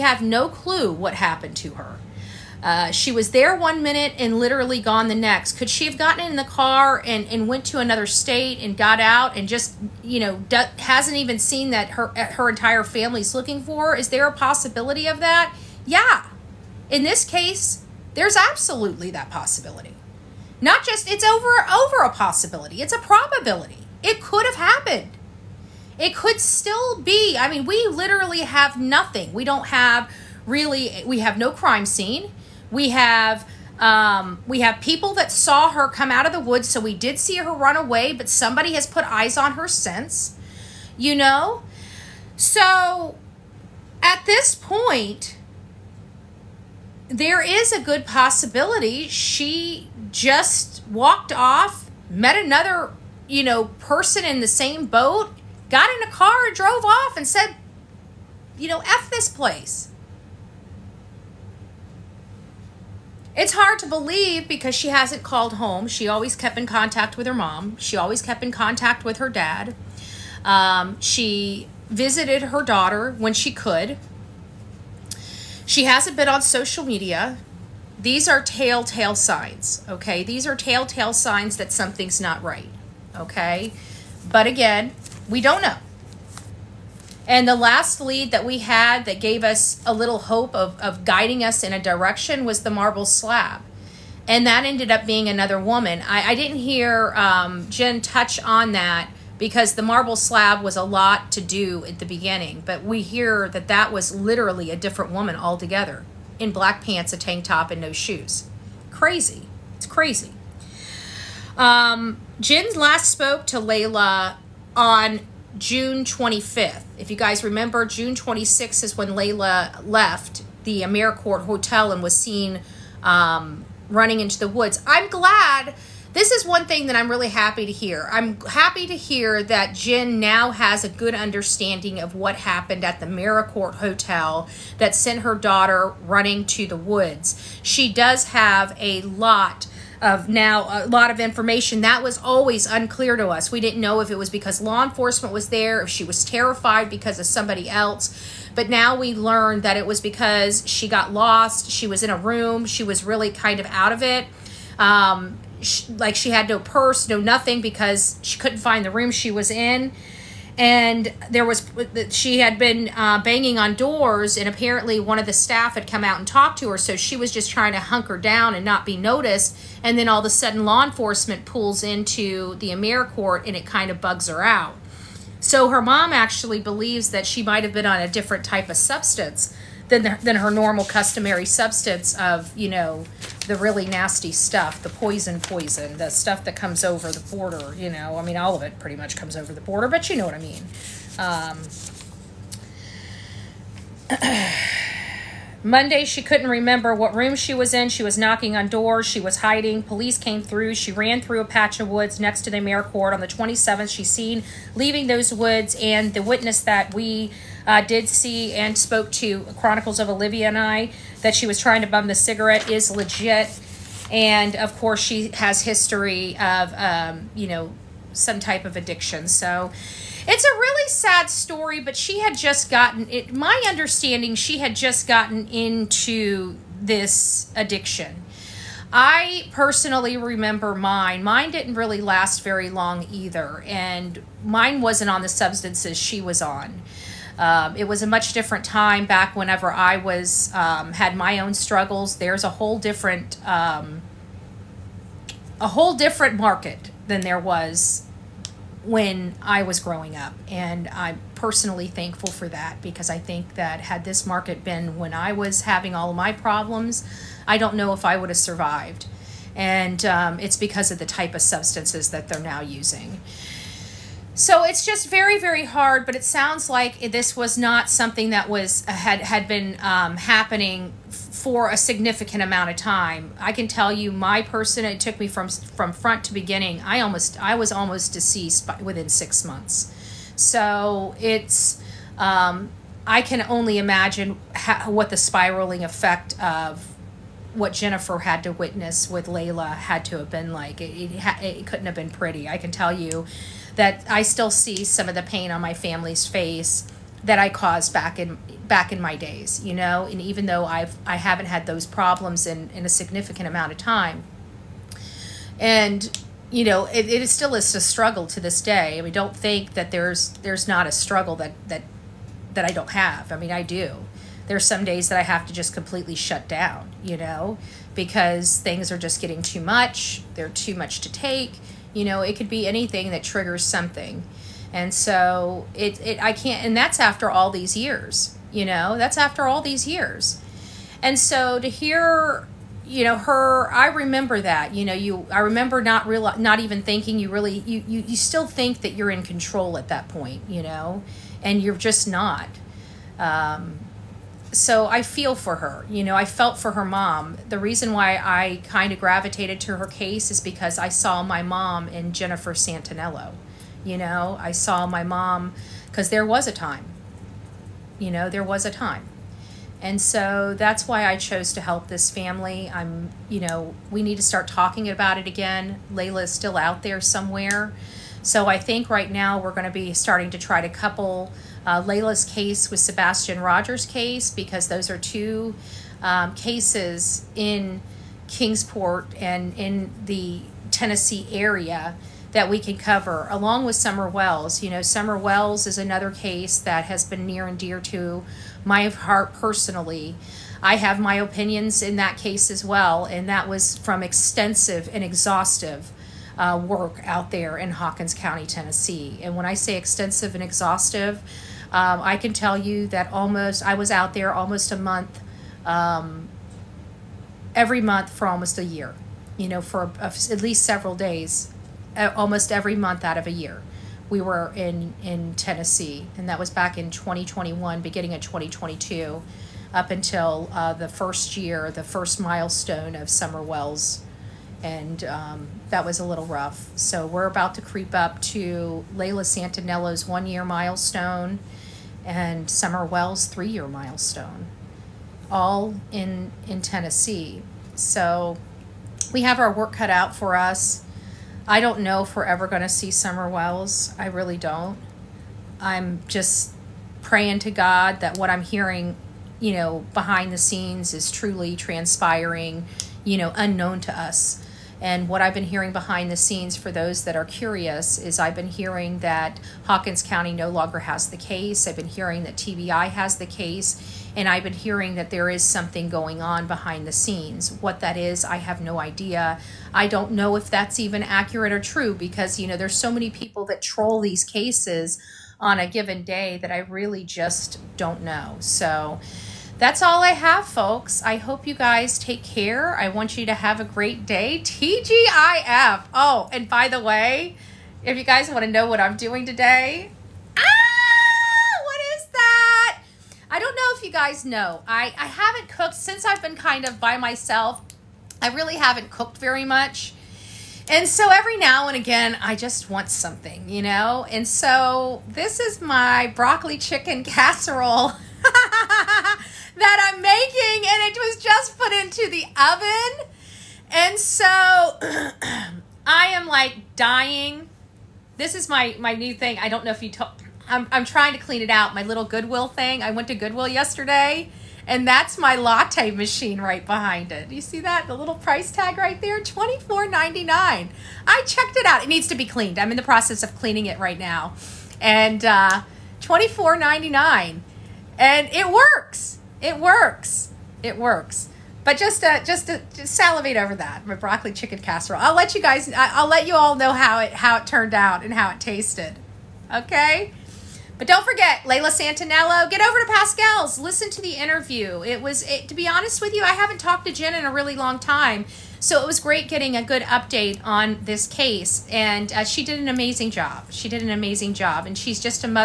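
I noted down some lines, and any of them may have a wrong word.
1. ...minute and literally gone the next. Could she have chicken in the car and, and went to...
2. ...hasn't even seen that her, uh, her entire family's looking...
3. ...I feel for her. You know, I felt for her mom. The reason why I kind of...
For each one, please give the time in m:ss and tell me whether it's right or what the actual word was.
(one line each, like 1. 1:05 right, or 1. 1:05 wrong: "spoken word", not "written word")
1. 0:03 wrong: "gotten", not "chicken"
2. 0:10 right
3. 5:44 right.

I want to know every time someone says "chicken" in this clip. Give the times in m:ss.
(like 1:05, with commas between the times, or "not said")
8:26, 9:04.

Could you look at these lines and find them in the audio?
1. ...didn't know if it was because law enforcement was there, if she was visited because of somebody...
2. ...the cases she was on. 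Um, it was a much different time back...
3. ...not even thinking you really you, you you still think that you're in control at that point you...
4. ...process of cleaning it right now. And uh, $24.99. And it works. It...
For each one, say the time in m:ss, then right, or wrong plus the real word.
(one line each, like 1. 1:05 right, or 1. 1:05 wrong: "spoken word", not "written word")
1. 2:23 wrong: "terrified", not "visited"
2. 3:55 wrong: "substances", not "cases"
3. 5:36 right
4. 8:52 right.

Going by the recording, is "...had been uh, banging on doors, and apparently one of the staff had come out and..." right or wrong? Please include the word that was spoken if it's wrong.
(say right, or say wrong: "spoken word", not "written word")
right.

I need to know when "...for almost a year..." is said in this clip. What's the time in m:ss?
6:48.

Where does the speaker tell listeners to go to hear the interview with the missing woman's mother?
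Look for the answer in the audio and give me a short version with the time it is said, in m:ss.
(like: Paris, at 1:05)
Pascal's, at 9:12.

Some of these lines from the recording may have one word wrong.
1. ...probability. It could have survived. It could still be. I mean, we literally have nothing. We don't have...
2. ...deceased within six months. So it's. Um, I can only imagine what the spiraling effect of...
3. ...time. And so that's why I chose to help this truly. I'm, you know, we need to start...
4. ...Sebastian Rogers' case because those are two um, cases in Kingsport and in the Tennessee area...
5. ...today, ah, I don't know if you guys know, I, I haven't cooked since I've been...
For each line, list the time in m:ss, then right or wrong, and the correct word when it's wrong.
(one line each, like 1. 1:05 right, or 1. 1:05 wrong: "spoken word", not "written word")
1. 0:22 wrong: "happened", not "survived"
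2. 4:38 right
3. 5:58 wrong: "family", not "truly"
4. 6:12 right
5. 8:09 right.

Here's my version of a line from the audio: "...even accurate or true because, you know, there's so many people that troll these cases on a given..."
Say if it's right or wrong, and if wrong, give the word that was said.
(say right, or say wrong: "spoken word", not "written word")
right.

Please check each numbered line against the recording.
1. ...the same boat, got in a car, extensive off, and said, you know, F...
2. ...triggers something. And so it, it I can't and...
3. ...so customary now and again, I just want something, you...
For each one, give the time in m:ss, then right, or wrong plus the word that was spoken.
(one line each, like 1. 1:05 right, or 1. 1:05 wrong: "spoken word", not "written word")
1. 0:54 wrong: "drove", not "extensive"
2. 5:23 right
3. 8:20 wrong: "every", not "customary".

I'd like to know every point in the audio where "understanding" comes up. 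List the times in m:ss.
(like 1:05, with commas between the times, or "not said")
2:11, 3:43.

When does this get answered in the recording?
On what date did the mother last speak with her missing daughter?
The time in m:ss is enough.
1:55.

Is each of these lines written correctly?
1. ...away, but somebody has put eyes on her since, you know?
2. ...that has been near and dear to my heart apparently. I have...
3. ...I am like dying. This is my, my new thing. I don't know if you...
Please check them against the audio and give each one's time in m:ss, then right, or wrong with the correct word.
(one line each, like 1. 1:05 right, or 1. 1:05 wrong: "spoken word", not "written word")
1. 0:37 right
2. 6:26 wrong: "personally", not "apparently"
3. 8:35 right.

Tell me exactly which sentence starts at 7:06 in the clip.
So we're about to creep up to Layla Santanello's one year milestone and Summer Wells' three year milestone, all in, in Tennessee.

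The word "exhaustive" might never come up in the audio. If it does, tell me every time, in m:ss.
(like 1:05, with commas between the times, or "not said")
6:35, 6:40.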